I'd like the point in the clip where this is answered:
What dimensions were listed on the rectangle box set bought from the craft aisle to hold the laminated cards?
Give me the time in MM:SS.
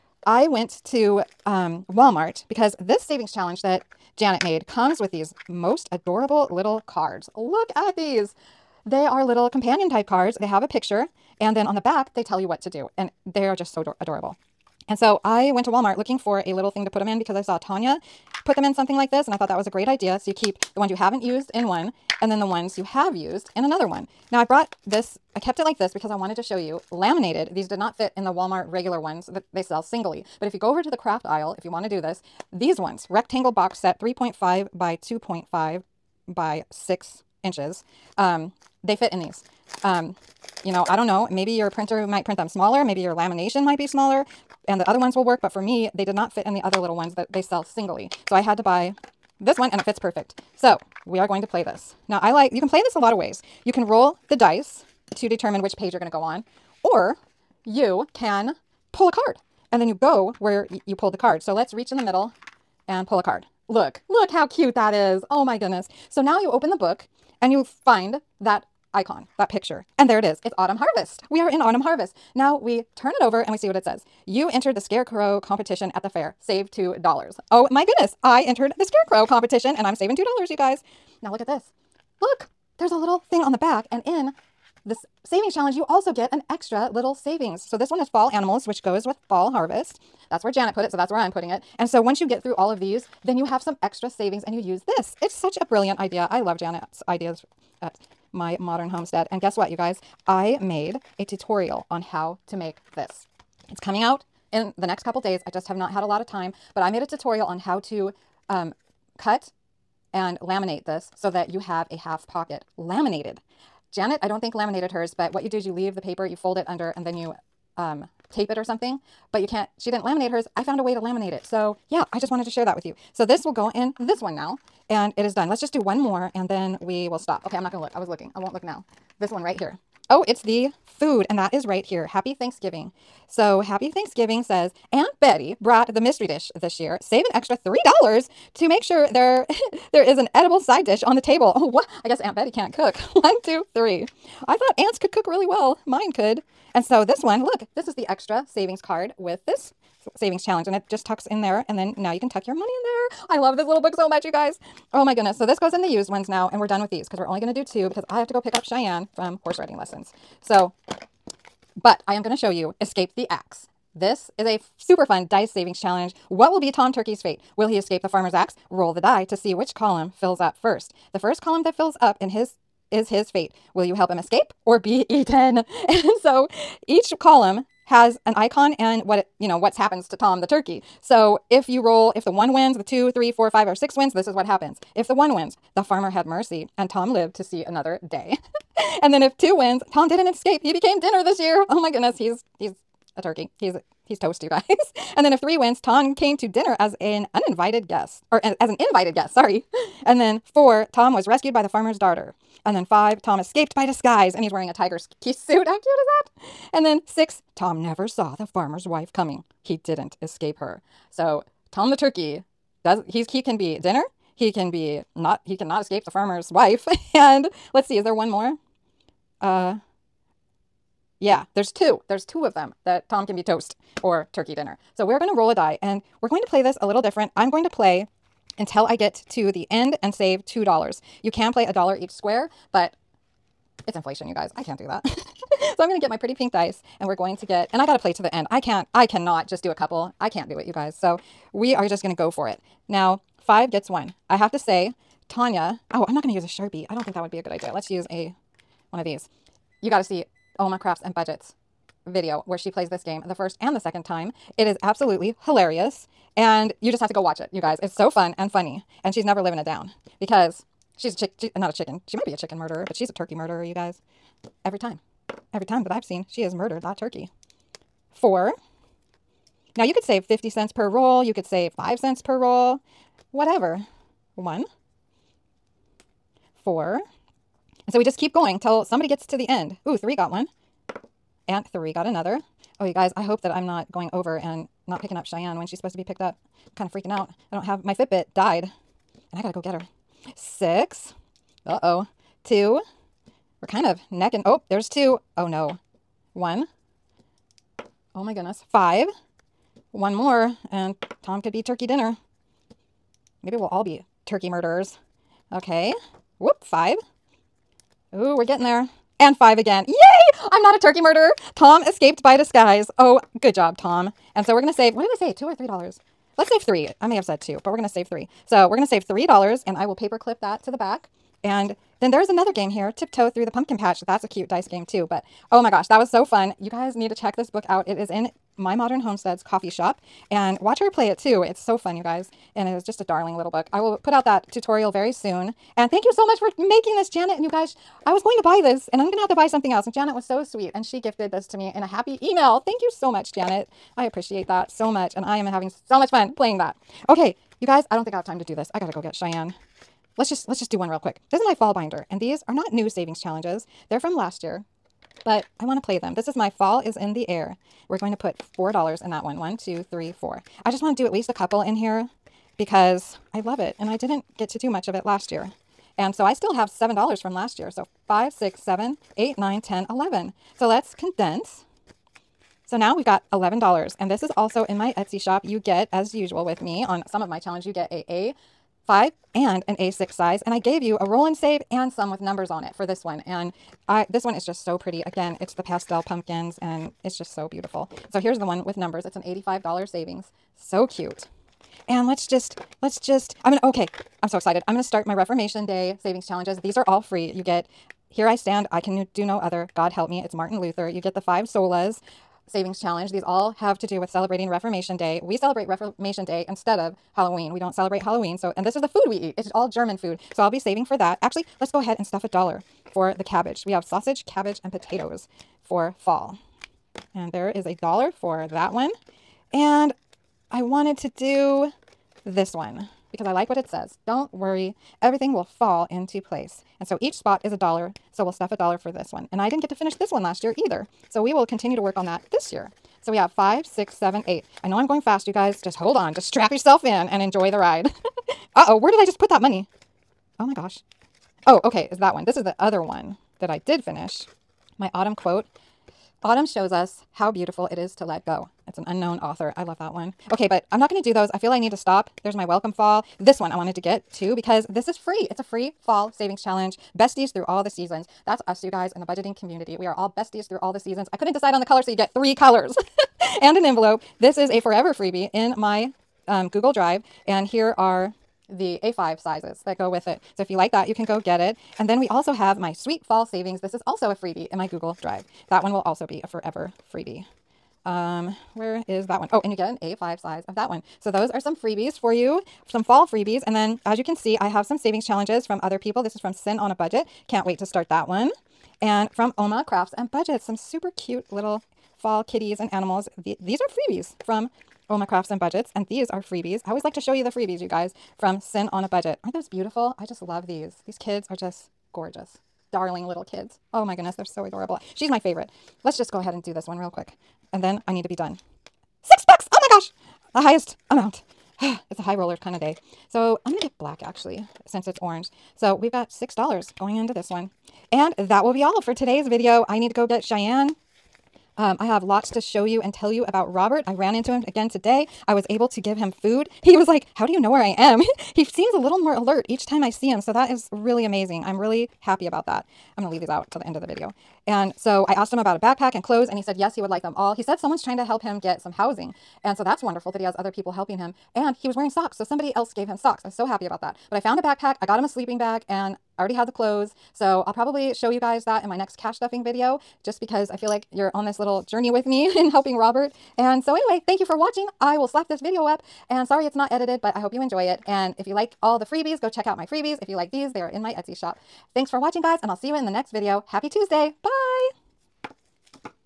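00:33.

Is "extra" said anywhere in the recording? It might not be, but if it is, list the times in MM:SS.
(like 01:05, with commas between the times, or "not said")
01:26, 01:33, 02:17, 02:28.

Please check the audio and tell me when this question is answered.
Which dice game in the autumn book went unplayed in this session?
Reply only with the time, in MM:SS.
05:22.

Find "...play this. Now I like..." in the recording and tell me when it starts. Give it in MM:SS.
00:51.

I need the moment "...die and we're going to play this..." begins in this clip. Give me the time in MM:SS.
03:45.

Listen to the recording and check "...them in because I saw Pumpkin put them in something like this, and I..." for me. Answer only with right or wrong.
wrong.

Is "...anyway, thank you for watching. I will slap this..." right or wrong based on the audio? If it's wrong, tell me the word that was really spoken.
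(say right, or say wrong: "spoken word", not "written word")
right.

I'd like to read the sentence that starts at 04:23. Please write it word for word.
You guys, every time, every time that I've seen, she has murdered that turkey.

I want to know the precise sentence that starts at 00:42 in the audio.
Maybe your lamination might be smaller and the other ones will work.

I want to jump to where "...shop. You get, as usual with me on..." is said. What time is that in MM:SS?
06:15.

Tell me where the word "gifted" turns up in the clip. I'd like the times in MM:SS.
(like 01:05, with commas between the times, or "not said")
05:40.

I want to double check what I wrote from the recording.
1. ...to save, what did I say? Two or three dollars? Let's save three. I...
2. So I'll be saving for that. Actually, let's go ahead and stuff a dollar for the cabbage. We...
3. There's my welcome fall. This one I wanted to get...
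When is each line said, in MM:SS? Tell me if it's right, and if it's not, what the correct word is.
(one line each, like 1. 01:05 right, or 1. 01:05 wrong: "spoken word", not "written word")
1. 05:14 right
2. 06:50 right
3. 07:32 right.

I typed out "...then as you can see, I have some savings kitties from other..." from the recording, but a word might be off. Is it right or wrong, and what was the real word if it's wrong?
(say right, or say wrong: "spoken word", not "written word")
wrong: "challenges", not "kitties".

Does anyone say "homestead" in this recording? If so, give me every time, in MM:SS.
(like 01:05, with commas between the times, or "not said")
01:38, 05:29.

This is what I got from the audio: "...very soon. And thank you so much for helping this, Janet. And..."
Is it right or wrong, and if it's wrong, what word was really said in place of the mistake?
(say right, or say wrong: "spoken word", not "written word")
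wrong: "making", not "helping".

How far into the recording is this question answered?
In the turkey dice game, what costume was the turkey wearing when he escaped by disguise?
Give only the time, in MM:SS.
03:24.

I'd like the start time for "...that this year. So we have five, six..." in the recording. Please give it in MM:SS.
07:12.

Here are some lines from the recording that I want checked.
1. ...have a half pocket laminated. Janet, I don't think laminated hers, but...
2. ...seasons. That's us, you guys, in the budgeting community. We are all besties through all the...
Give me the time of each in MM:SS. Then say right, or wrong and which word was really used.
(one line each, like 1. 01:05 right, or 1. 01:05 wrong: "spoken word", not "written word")
1. 01:51 right
2. 07:37 right.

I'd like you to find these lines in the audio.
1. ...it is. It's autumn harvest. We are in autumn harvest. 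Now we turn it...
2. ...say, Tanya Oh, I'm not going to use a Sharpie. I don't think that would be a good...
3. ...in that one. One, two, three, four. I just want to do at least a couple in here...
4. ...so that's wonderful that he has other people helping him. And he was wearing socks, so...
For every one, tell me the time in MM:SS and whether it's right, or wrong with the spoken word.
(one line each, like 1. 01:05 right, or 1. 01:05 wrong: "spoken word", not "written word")
1. 01:10 right
2. 04:04 right
3. 05:59 right
4. 08:59 right.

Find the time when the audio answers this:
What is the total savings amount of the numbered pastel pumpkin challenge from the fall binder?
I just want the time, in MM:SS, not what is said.
06:29.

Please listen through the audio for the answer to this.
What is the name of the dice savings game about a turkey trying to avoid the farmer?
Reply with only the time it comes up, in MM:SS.
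02:42.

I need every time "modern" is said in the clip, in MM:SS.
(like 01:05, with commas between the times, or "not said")
01:38, 05:28.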